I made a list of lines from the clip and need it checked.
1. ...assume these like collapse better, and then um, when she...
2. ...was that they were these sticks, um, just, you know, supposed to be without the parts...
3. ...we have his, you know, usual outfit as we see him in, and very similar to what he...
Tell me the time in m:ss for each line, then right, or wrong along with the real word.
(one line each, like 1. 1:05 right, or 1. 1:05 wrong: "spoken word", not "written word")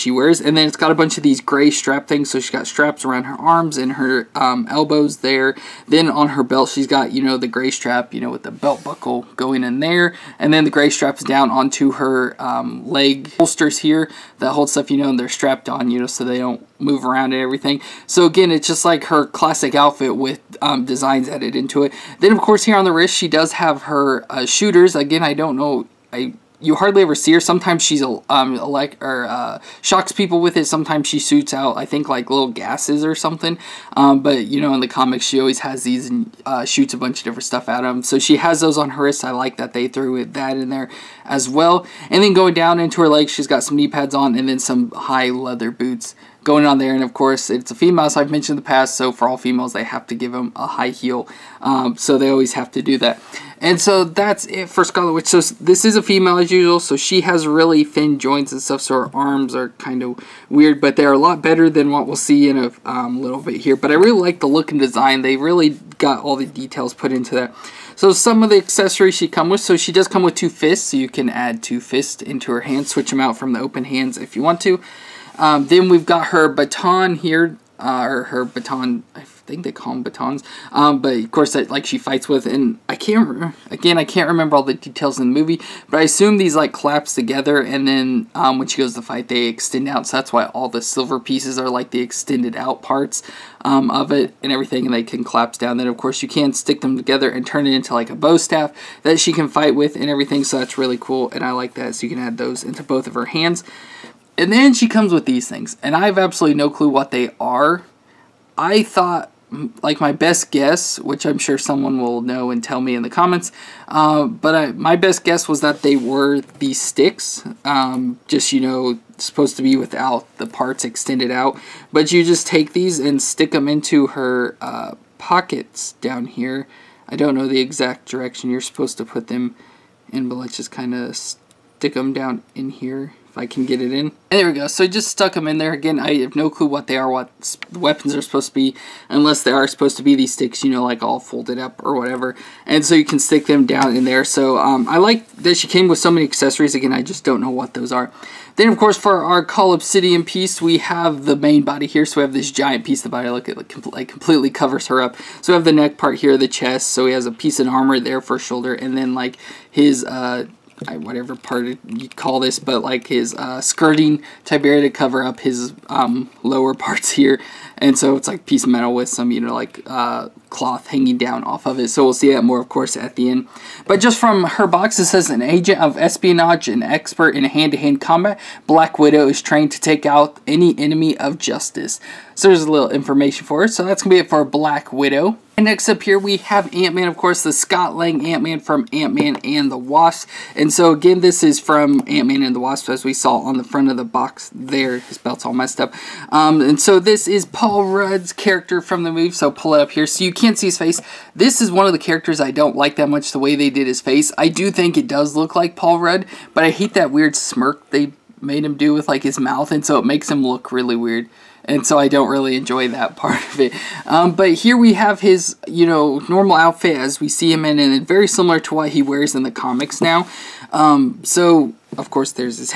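1. 1:26 wrong: "together", not "better"
2. 1:55 right
3. 3:34 wrong: "normal", not "usual".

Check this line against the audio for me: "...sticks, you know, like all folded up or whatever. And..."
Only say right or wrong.
right.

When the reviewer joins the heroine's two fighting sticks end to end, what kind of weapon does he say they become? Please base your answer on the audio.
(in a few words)
bow staff.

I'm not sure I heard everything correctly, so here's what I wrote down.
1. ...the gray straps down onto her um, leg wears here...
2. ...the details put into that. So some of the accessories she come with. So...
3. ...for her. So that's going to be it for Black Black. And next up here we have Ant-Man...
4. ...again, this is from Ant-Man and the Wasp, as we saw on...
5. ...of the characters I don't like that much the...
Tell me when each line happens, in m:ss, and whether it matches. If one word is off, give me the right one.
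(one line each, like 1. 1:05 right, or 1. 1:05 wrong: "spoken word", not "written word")
1. 0:10 wrong: "holsters", not "wears"
2. 1:06 right
3. 3:03 wrong: "Widow", not "Black"
4. 3:10 right
5. 3:21 right.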